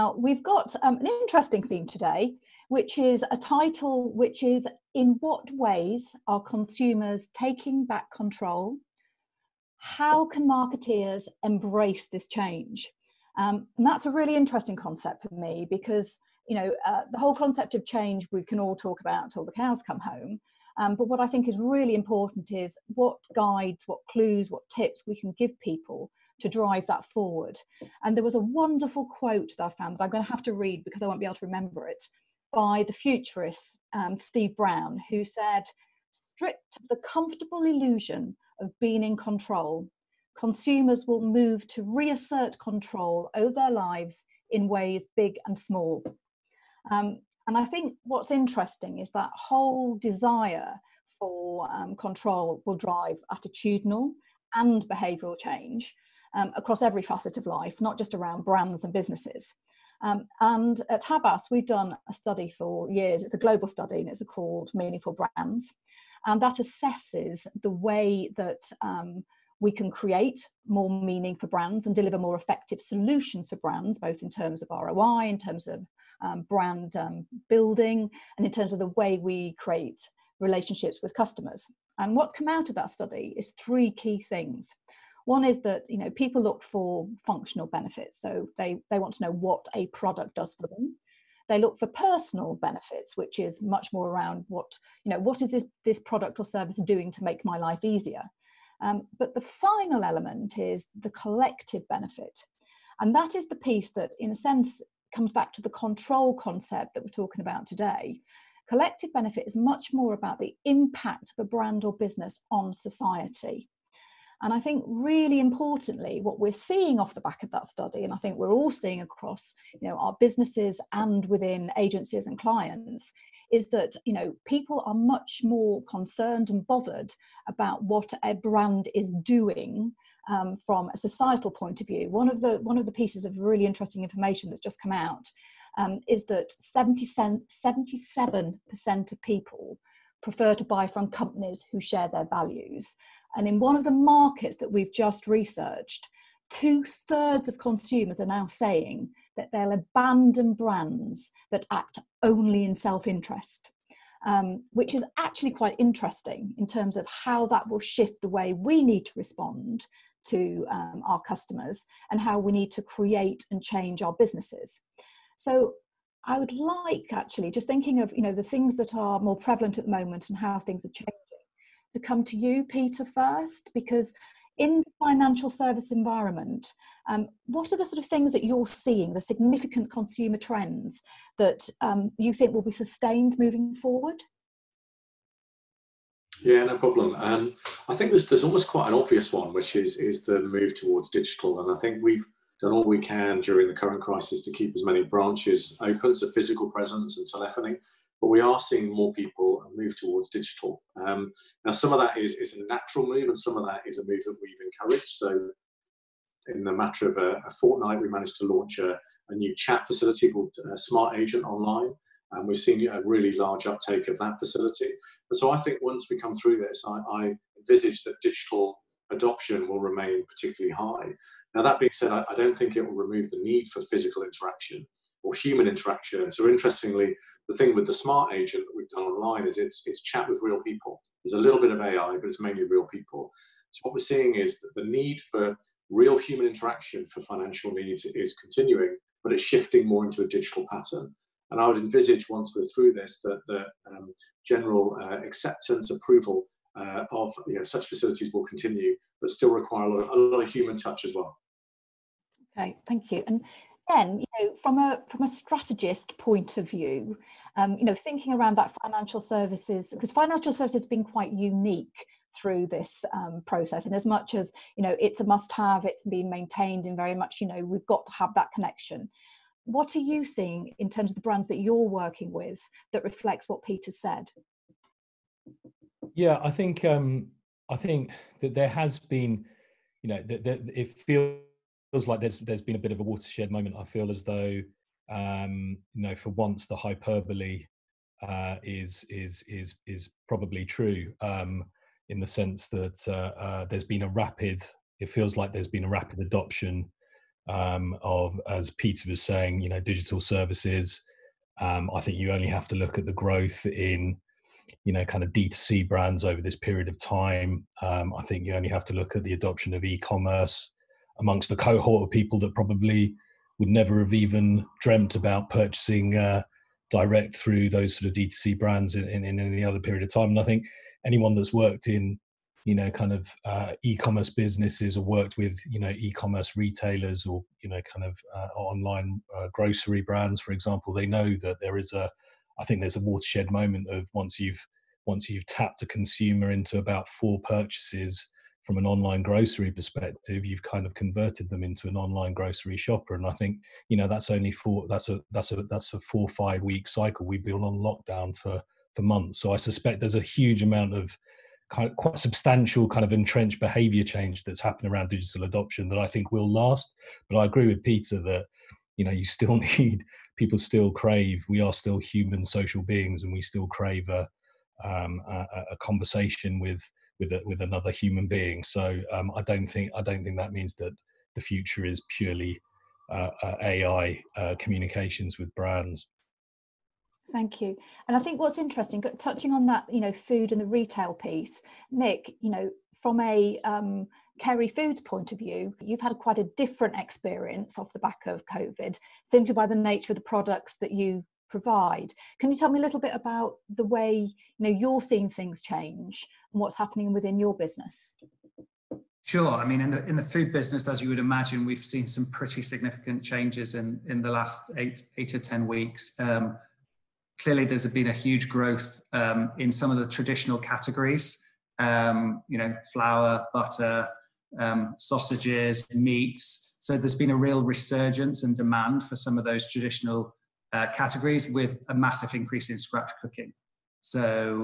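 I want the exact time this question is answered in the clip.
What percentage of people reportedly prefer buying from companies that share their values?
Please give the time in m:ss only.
2:16.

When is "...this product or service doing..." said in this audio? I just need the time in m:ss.
1:35.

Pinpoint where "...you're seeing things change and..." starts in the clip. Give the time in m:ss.
6:34.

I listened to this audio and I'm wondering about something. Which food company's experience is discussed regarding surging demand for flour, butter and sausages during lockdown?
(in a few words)
Kerry Foods.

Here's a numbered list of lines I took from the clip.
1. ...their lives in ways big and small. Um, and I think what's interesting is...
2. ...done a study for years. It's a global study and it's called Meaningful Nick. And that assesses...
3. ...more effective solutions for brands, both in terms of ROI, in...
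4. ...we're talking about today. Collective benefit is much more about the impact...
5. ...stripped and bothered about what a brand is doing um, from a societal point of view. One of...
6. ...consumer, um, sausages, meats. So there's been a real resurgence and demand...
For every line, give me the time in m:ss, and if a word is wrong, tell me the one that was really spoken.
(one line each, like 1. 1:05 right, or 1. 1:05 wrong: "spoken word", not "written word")
1. 0:43 right
2. 1:01 wrong: "Brands", not "Nick"
3. 1:12 right
4. 1:47 right
5. 2:05 wrong: "concerned", not "stripped"
6. 6:53 wrong: "butter", not "consumer".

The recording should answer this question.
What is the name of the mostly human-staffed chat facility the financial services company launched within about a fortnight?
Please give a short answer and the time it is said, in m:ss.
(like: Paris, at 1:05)
Smart Agent Online, at 3:30.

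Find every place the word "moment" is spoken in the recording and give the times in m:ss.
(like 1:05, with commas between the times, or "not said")
2:49, 4:43, 5:33.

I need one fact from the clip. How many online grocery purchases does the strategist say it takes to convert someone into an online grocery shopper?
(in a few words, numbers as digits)
4.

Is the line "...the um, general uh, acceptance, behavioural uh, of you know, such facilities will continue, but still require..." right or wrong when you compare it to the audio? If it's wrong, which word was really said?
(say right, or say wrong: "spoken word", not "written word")
wrong: "approval", not "behavioural".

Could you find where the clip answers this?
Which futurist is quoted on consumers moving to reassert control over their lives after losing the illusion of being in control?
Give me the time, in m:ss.
0:34.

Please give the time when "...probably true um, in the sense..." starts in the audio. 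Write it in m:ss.
4:50.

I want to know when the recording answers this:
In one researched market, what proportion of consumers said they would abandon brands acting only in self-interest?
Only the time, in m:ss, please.
2:26.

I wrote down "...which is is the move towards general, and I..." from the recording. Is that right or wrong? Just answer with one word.
wrong.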